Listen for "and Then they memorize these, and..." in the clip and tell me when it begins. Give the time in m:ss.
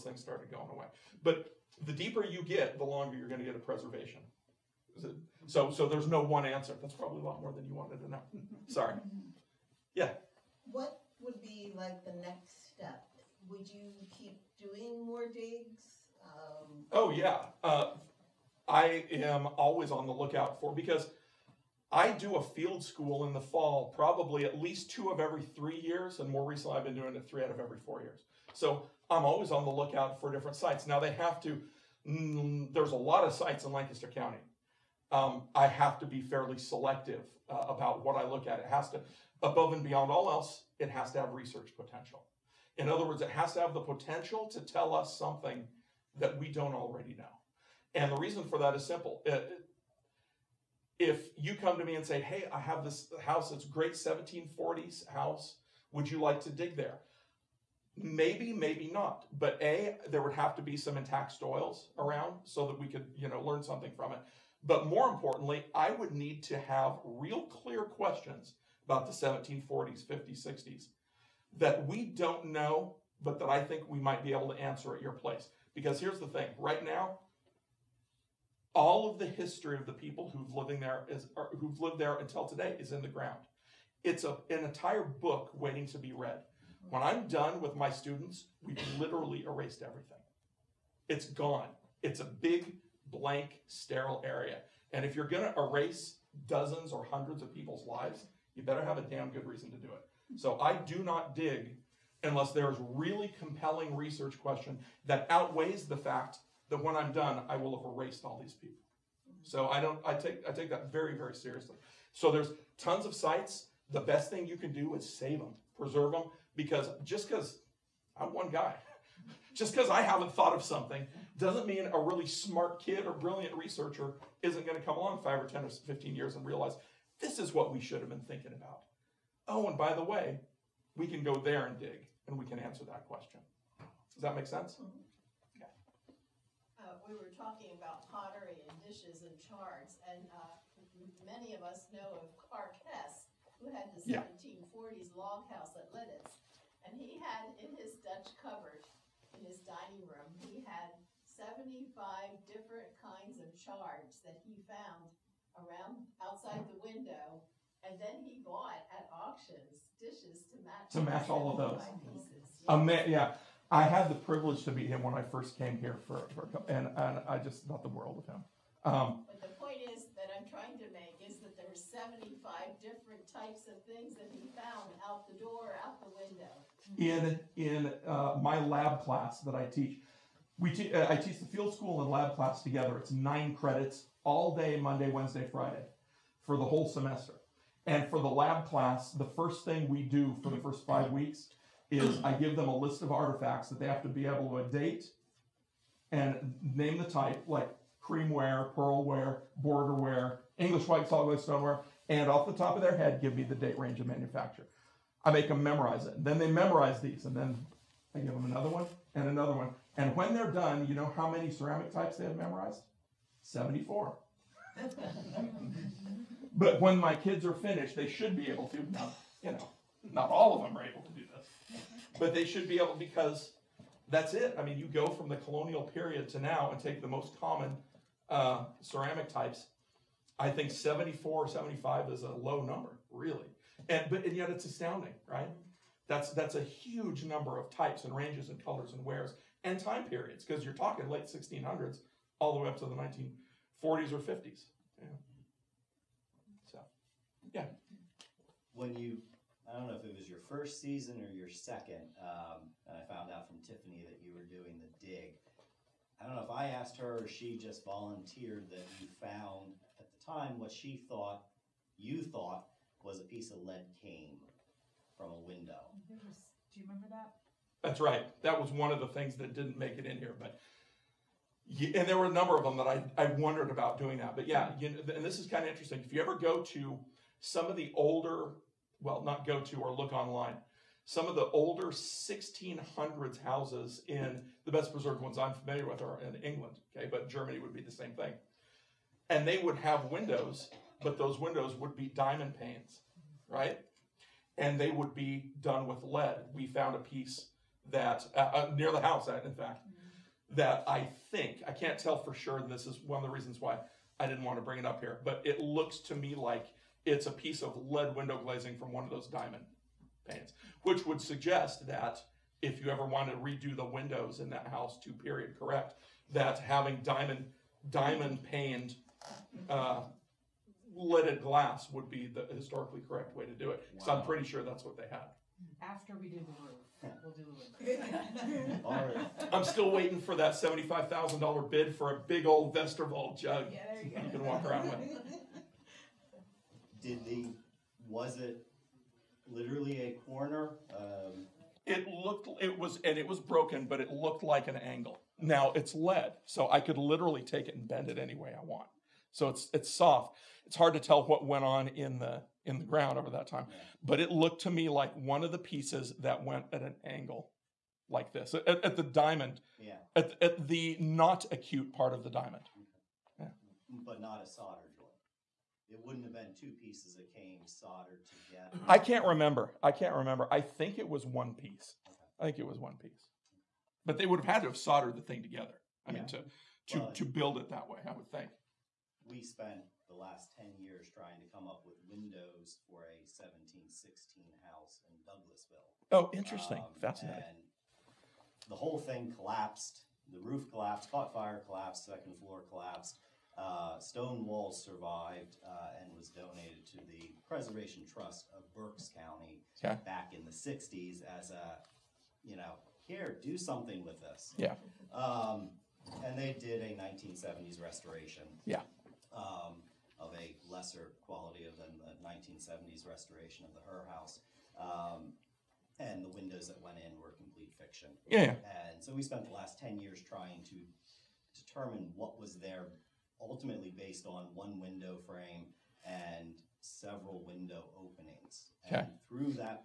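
3:26.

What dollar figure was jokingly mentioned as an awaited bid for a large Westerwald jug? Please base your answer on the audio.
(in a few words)
$75,000.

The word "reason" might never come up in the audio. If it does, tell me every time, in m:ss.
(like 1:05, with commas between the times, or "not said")
0:48, 1:39, 5:03.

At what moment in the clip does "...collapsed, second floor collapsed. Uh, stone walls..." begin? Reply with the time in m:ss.
6:31.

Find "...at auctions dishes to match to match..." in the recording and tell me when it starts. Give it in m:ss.
2:38.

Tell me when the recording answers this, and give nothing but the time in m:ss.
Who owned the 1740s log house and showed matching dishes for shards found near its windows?
2:22.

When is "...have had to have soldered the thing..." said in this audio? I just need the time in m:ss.
6:14.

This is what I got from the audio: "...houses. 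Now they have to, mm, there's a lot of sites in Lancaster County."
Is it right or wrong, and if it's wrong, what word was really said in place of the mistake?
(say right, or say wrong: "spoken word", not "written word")
wrong: "sites", not "houses".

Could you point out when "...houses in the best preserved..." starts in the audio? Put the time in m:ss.
4:43.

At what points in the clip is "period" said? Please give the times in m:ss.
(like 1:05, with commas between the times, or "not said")
3:45, 4:00, 5:15.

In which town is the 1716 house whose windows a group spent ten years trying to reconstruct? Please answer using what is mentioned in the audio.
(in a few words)
Douglasville.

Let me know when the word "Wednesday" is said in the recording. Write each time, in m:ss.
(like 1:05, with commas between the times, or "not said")
3:05.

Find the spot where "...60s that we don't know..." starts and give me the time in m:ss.
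1:10.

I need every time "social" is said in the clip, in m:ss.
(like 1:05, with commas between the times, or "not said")
not said.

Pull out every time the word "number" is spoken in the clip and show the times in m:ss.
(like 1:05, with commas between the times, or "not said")
3:52, 3:57, 4:32.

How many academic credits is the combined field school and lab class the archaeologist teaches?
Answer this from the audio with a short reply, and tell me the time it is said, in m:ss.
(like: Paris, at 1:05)
9, at 3:03.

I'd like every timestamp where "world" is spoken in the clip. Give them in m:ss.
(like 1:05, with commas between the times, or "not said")
2:47.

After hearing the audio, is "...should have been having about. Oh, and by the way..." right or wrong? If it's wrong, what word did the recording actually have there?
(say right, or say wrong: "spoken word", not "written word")
wrong: "thinking", not "having".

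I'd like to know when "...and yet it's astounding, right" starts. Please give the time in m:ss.
3:54.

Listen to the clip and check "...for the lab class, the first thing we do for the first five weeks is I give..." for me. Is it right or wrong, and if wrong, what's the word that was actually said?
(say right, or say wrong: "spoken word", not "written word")
right.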